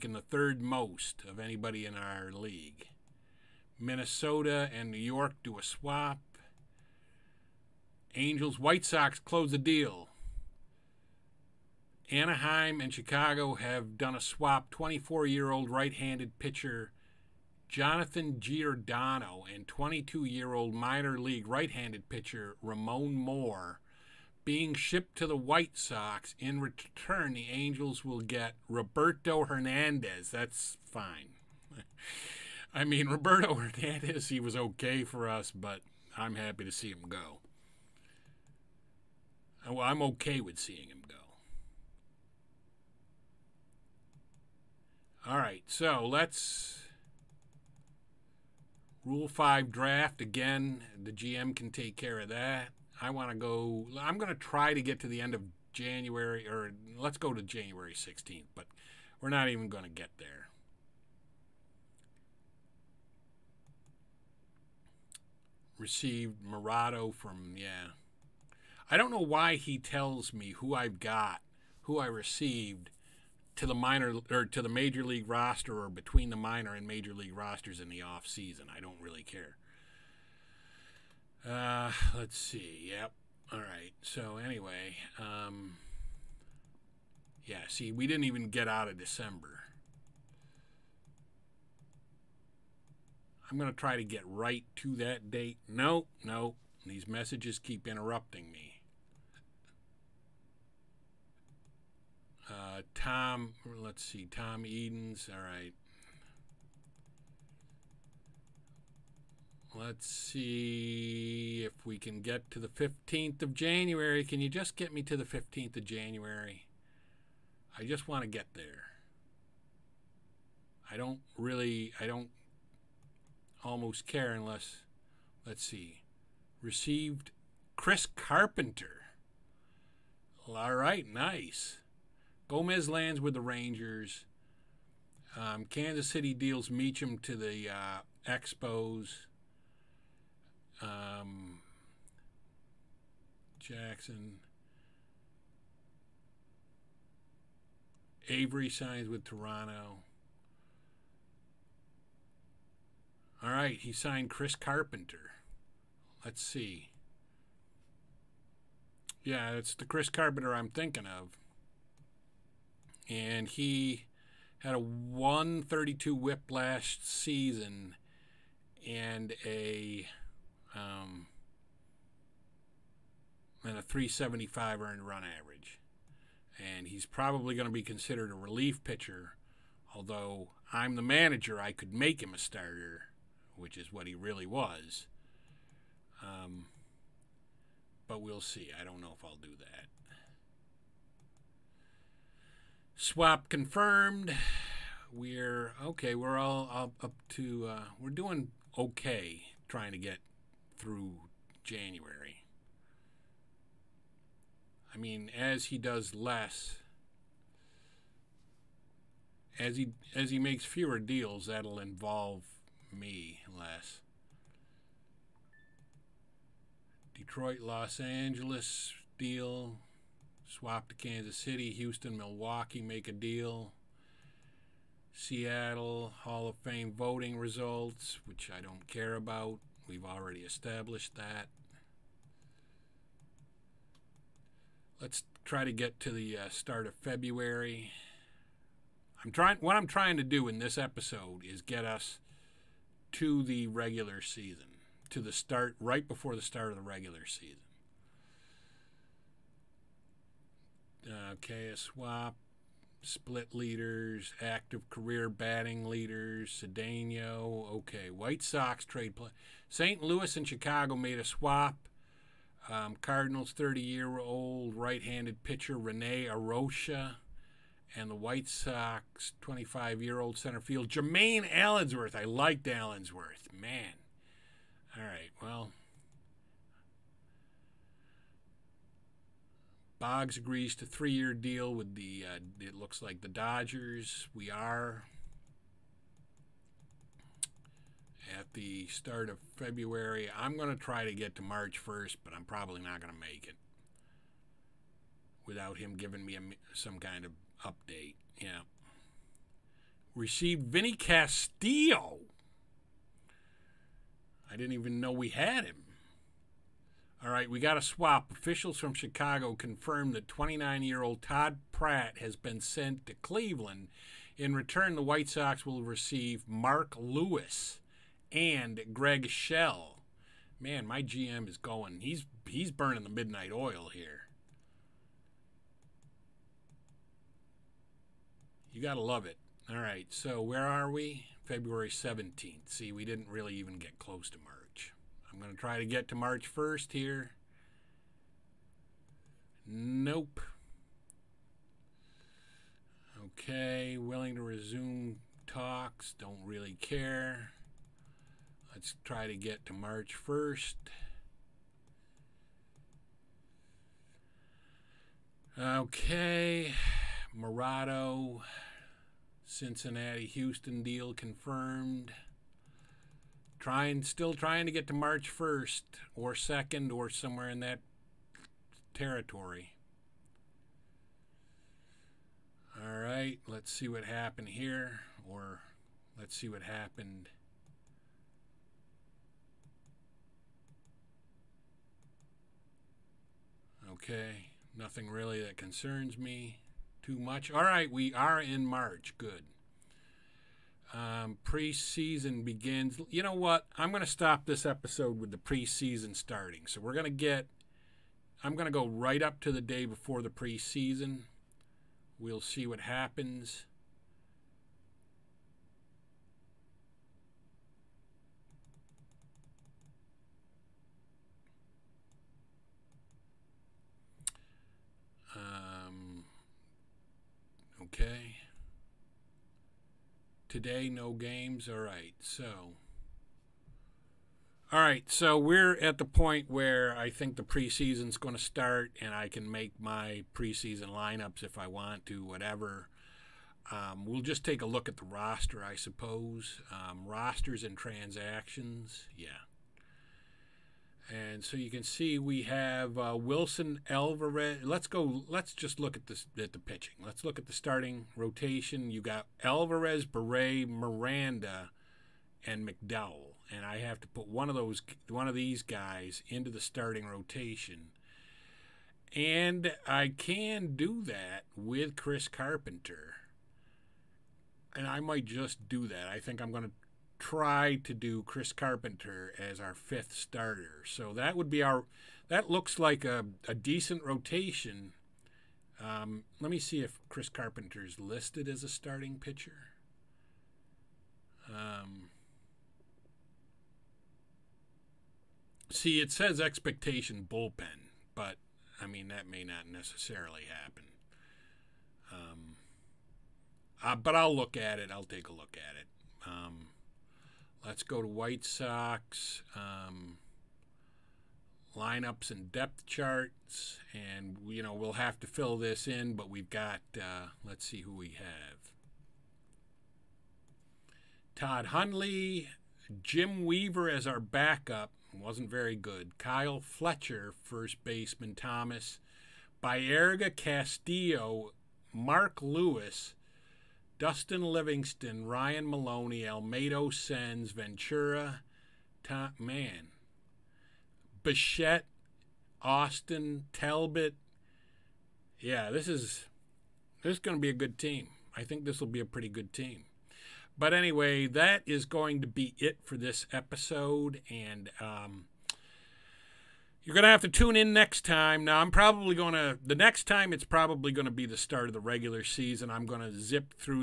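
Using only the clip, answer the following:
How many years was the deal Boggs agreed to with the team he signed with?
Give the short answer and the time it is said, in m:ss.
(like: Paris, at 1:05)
3, at 4:40.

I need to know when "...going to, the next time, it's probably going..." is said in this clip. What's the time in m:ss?
9:09.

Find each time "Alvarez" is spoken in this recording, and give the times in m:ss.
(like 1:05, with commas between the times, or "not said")
7:23, 7:29.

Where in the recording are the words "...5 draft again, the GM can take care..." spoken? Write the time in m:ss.
0:49.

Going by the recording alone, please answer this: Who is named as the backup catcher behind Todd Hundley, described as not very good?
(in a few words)
Jim Weaver.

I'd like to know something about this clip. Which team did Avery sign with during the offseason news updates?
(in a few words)
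Toronto.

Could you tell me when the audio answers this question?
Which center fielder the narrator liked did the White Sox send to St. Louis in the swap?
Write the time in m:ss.
4:30.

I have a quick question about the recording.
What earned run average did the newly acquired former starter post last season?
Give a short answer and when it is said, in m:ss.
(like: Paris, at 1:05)
3.75, at 2:53.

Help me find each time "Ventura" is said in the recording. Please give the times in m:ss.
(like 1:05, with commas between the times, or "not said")
8:47.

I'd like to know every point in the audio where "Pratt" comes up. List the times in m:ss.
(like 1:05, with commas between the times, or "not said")
5:11.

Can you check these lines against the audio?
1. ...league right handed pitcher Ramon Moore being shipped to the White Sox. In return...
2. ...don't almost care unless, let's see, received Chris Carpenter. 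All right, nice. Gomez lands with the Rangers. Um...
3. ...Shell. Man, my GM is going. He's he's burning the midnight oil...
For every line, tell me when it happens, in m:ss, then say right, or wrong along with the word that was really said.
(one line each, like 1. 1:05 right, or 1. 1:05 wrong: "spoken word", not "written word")
1. 0:21 right
2. 2:02 right
3. 5:19 right.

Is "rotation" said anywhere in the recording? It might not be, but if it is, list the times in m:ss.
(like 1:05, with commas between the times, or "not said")
7:28, 7:37, 7:54.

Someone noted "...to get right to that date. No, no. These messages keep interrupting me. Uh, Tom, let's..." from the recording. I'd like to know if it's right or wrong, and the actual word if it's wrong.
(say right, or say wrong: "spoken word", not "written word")
right.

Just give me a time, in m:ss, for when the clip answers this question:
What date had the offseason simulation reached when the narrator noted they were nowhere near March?
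5:31.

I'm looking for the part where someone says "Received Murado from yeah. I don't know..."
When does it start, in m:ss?
1:05.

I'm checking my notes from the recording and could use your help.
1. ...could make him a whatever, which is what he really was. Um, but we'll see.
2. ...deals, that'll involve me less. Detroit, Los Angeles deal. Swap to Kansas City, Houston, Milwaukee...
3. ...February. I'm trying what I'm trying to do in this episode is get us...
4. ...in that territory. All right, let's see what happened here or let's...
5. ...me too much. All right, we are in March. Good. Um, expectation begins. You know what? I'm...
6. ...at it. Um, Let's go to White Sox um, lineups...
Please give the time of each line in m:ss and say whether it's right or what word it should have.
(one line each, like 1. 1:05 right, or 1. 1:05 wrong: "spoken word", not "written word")
1. 3:01 wrong: "starter", not "whatever"
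2. 3:30 right
3. 3:56 right
4. 6:07 right
5. 6:26 wrong: "preseason", not "expectation"
6. 8:15 right.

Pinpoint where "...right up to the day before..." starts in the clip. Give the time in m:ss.
6:38.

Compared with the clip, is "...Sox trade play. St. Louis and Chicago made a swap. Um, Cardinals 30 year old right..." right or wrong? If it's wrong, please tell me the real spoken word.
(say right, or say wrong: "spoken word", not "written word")
right.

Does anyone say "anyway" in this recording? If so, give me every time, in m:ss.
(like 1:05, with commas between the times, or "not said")
1:24, 9:00.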